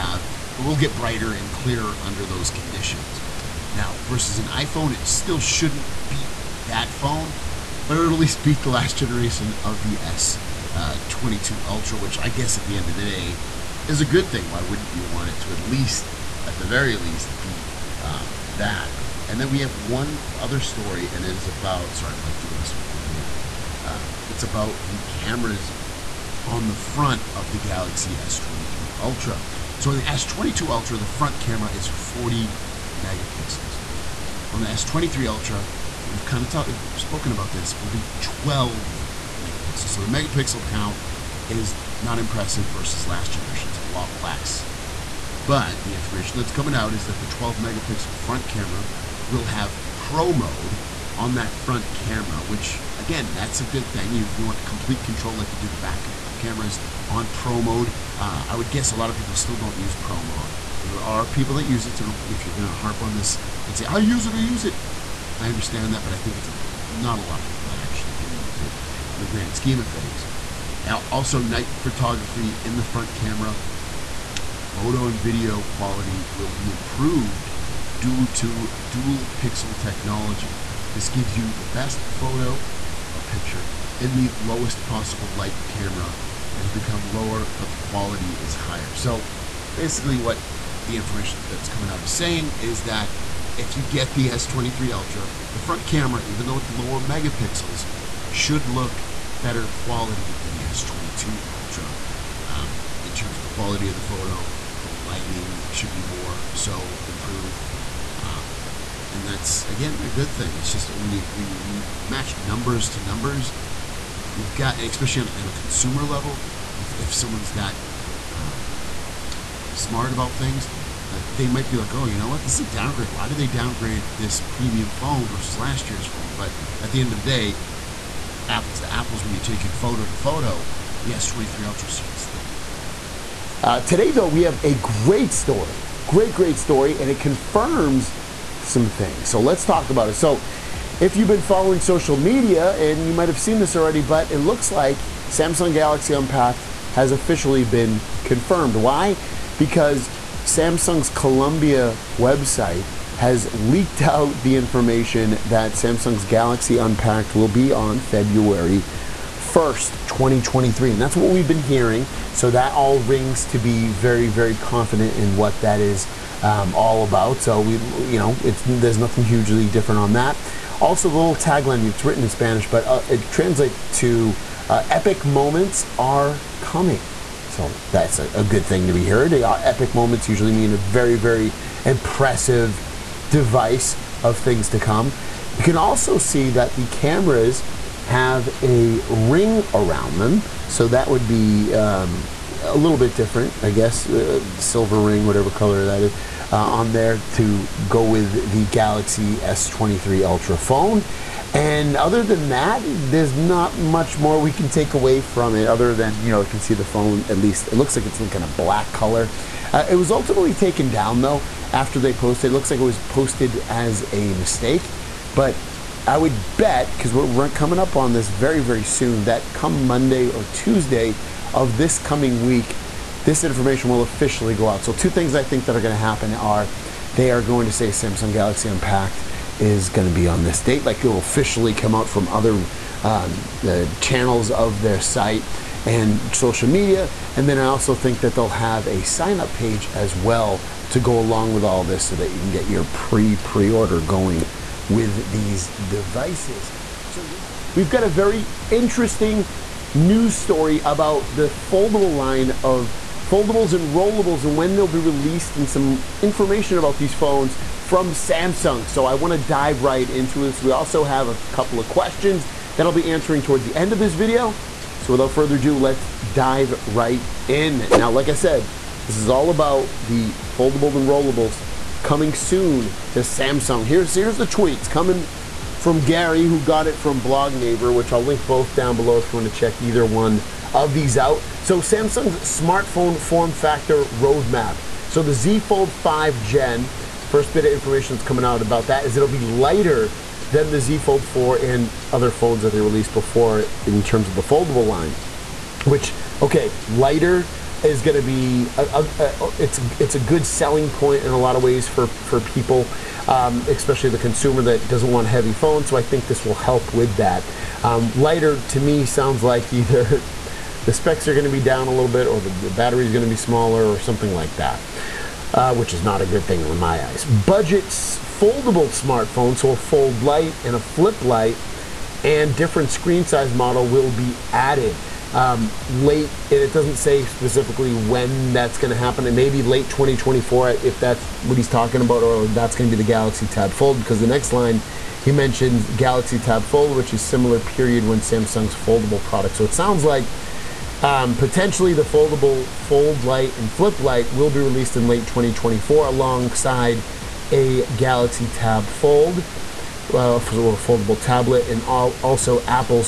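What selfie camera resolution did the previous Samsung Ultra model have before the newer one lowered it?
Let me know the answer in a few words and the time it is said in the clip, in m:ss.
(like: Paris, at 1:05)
40 megapixels, at 0:31.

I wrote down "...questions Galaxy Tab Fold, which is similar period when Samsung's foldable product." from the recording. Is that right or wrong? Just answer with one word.
wrong.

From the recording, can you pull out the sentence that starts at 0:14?
Why wouldn't you want it to at least, at the very least, beat um, that?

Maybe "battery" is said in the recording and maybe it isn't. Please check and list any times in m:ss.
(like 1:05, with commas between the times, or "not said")
5:12.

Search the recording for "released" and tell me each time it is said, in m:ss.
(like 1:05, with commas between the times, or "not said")
4:14, 4:52, 5:44.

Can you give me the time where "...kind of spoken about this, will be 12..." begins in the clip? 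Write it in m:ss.
0:36.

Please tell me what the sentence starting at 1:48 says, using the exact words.
Um, and that's again a good thing.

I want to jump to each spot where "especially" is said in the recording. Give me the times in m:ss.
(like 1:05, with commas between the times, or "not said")
1:54, 5:03.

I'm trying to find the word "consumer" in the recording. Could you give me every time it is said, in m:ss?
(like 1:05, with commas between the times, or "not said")
1:55, 5:04.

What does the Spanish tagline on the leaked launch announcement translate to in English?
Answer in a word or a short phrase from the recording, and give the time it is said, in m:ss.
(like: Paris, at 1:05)
Epic moments are coming, at 2:54.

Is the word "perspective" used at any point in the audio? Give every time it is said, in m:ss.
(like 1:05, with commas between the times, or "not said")
not said.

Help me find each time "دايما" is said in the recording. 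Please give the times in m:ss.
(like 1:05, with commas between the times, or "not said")
not said.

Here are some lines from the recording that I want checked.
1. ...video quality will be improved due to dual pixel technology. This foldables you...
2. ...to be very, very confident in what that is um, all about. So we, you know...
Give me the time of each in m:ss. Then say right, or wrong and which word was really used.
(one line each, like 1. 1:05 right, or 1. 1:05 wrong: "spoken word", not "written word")
1. 1:15 wrong: "gives", not "foldables"
2. 2:43 right.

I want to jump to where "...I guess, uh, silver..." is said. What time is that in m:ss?
3:13.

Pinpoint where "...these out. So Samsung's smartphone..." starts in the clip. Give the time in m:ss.
4:40.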